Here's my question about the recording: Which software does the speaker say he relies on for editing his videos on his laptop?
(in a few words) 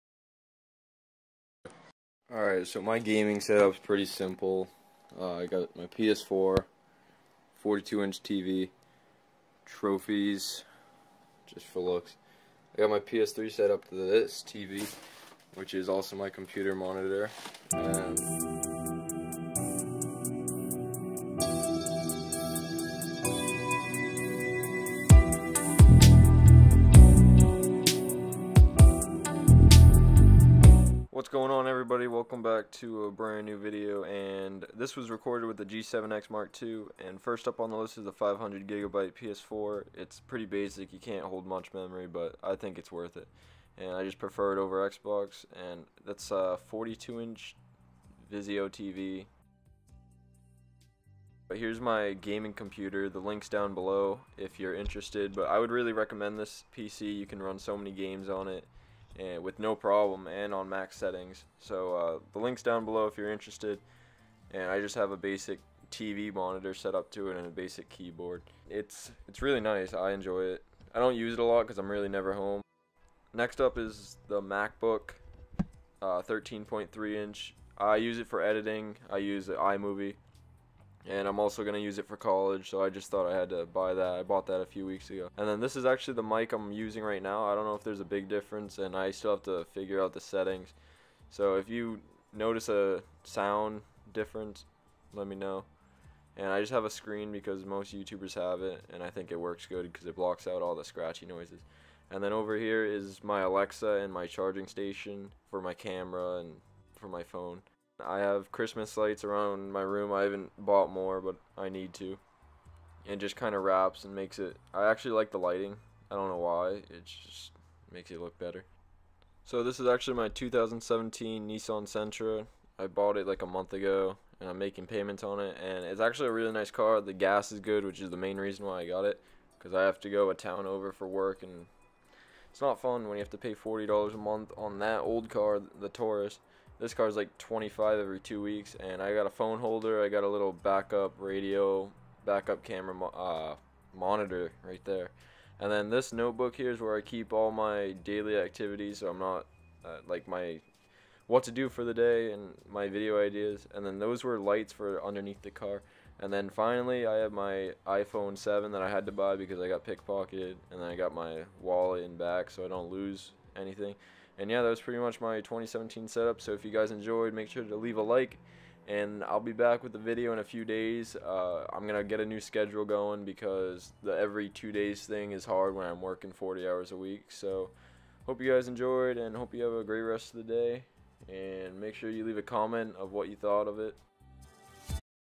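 iMovie.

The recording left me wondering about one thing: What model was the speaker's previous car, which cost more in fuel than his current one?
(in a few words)
Taurus.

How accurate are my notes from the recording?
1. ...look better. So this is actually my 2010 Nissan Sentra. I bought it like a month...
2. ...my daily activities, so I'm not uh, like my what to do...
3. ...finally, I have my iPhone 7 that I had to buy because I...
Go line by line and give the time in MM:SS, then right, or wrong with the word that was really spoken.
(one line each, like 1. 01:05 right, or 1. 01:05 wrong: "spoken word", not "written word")
1. 01:58 wrong: "2017", not "2010"
2. 02:27 right
3. 02:36 right.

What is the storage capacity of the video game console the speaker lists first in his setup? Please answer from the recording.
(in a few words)
500 gigabytes.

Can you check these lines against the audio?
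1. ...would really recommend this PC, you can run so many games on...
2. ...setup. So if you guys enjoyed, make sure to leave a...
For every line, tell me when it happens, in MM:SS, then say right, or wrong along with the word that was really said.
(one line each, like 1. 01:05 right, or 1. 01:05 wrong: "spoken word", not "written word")
1. 00:55 right
2. 02:46 right.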